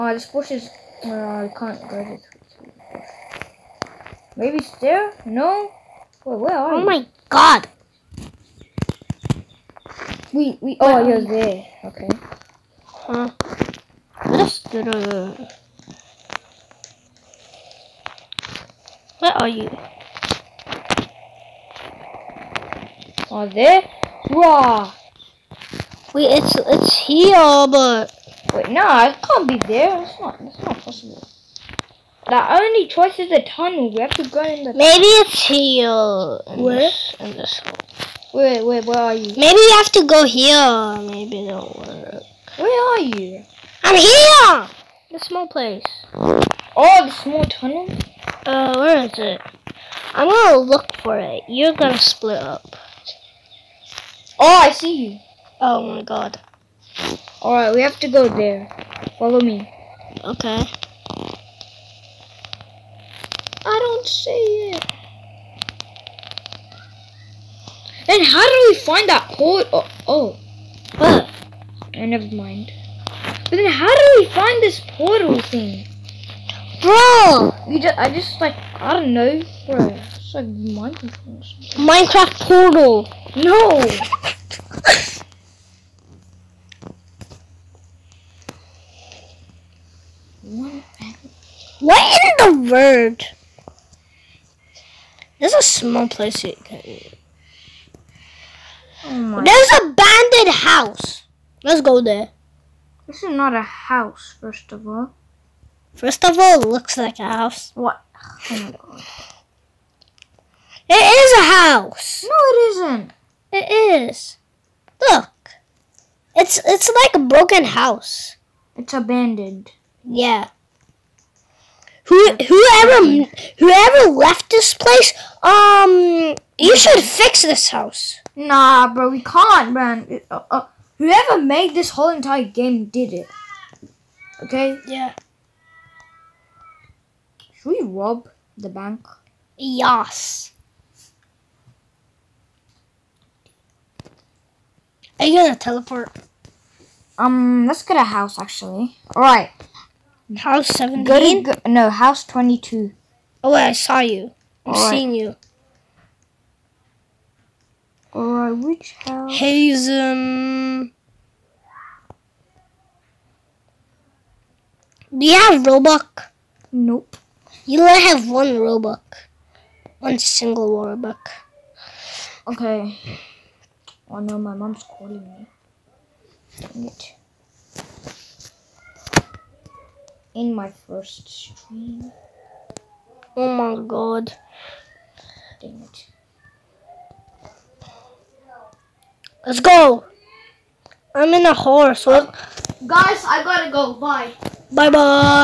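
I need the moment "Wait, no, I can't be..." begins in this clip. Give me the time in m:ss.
0:28.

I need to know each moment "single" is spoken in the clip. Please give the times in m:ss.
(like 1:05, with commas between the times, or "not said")
2:50.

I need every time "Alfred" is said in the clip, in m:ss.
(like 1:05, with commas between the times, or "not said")
not said.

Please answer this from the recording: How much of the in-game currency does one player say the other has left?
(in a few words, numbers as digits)
1 Robux.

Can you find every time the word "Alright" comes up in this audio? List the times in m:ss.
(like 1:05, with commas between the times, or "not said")
0:57, 2:29, 2:38.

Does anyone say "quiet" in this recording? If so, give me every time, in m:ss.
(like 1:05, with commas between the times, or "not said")
not said.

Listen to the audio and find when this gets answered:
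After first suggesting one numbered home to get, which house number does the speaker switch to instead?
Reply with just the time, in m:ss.
2:31.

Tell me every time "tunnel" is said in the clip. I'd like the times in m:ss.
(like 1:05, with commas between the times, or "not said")
0:33, 0:47.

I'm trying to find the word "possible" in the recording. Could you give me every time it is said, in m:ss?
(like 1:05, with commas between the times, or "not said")
0:30.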